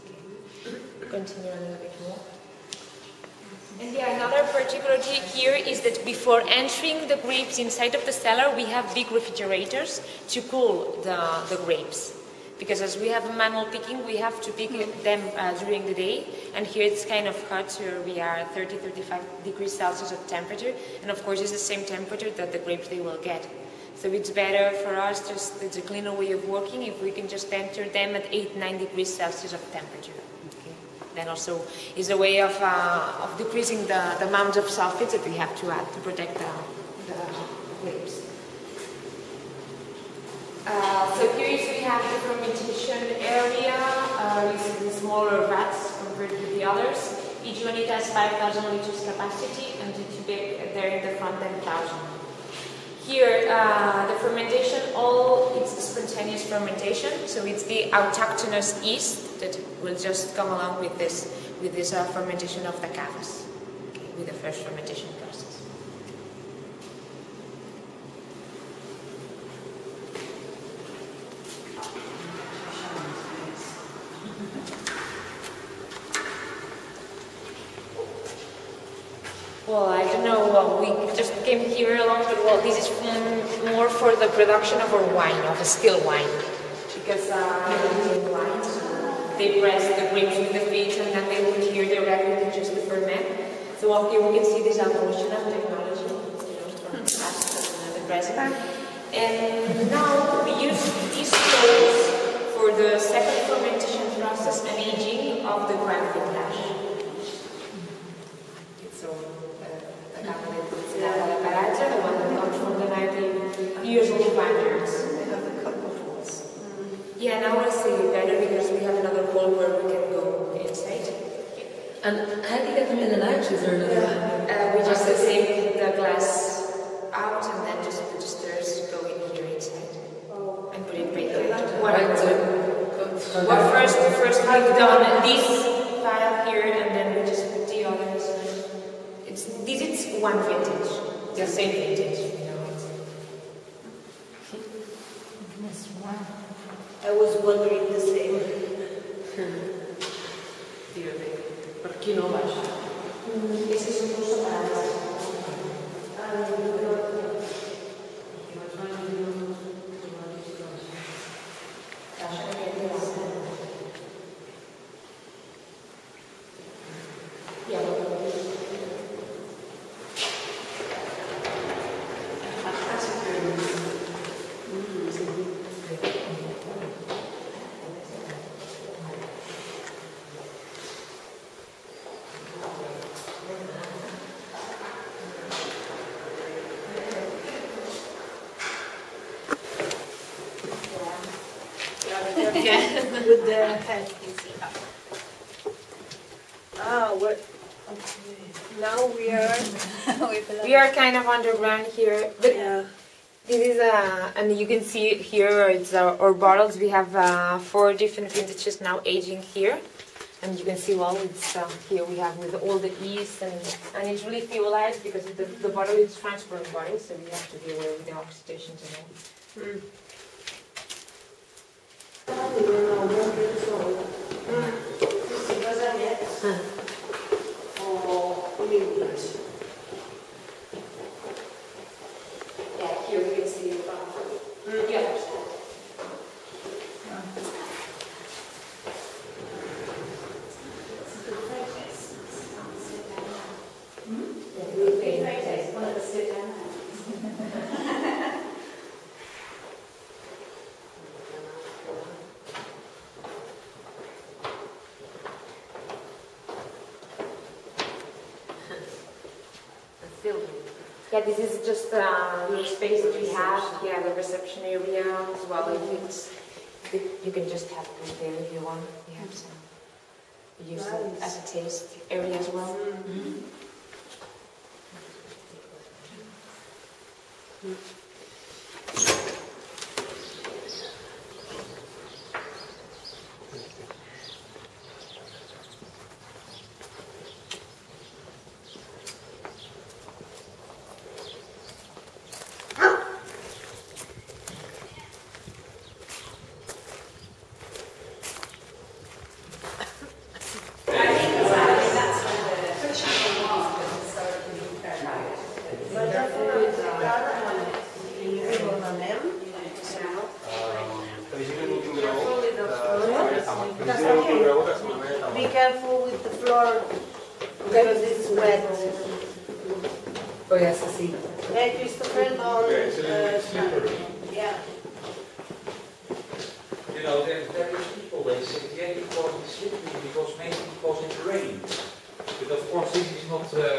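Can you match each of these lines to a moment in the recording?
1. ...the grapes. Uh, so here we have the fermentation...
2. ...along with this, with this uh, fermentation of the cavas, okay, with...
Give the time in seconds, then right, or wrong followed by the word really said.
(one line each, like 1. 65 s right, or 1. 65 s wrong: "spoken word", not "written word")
1. 37 s right
2. 60 s right.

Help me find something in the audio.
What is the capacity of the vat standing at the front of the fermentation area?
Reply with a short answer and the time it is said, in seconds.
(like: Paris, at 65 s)
10,000 liters, at 51 s.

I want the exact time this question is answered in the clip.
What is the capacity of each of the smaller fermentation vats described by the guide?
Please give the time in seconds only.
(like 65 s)
48 s.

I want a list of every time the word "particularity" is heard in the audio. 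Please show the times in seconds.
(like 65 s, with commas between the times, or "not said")
4 s.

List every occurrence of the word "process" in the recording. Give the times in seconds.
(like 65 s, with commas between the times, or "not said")
65 s, 104 s.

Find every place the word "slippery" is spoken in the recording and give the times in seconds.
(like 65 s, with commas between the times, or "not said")
329 s.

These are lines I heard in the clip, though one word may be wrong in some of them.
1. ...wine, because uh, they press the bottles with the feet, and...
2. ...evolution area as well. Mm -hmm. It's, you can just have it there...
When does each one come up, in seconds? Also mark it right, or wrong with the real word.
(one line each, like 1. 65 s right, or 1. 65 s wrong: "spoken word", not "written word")
1. 86 s wrong: "grapes", not "bottles"
2. 264 s wrong: "reception", not "evolution".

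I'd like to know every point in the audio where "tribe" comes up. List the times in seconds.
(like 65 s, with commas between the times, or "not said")
not said.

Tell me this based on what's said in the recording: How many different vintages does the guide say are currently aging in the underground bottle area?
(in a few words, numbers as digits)
4.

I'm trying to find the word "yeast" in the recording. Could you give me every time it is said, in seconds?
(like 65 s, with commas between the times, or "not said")
58 s, 213 s.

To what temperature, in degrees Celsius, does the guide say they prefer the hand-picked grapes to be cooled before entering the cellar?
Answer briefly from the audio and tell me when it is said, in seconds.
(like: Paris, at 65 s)
8-9 degrees Celsius, at 28 s.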